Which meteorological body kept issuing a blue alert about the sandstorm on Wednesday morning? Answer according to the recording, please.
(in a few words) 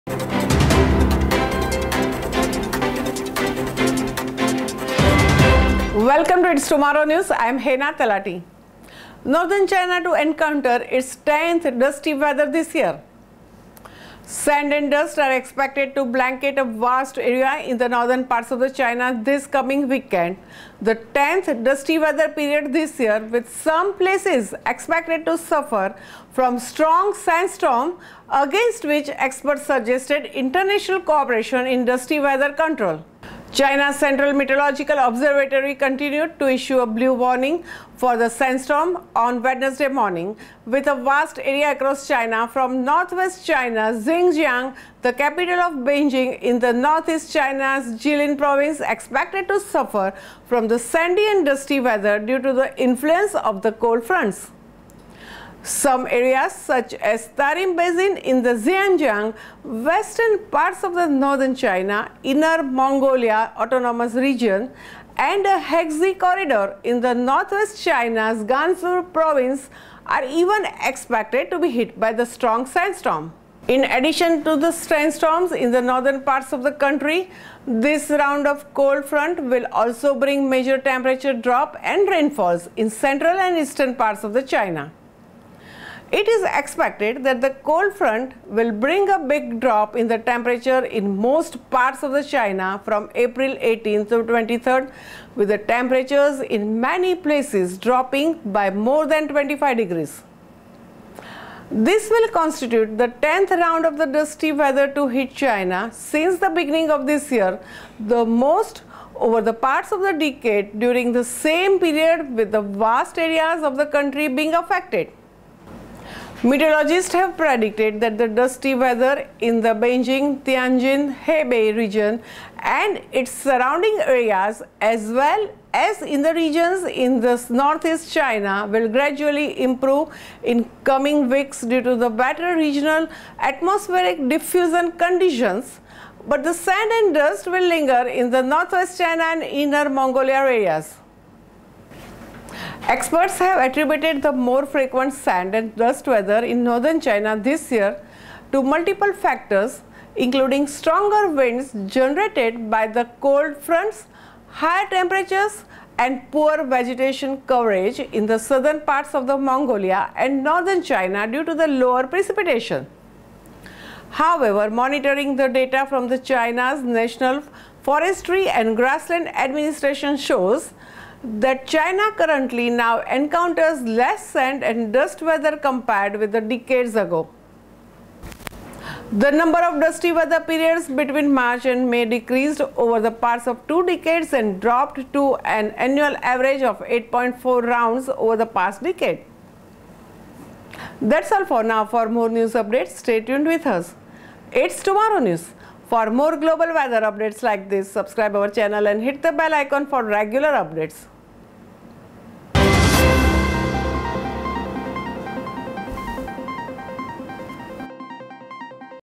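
Central Meteorological Observatory.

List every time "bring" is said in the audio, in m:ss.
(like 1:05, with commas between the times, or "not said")
1:20, 1:28.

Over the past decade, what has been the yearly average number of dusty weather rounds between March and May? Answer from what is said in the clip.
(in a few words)
8.4.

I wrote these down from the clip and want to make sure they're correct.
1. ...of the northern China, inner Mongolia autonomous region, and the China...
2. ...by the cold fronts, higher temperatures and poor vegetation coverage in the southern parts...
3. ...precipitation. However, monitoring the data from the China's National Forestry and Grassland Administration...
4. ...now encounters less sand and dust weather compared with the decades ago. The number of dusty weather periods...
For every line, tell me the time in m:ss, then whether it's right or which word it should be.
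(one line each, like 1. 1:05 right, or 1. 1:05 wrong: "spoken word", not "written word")
1. 1:00 wrong: "Hexi", not "China"
2. 2:32 right
3. 2:42 right
4. 2:52 right.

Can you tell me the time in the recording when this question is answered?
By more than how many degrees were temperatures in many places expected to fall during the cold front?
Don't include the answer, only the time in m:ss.
1:39.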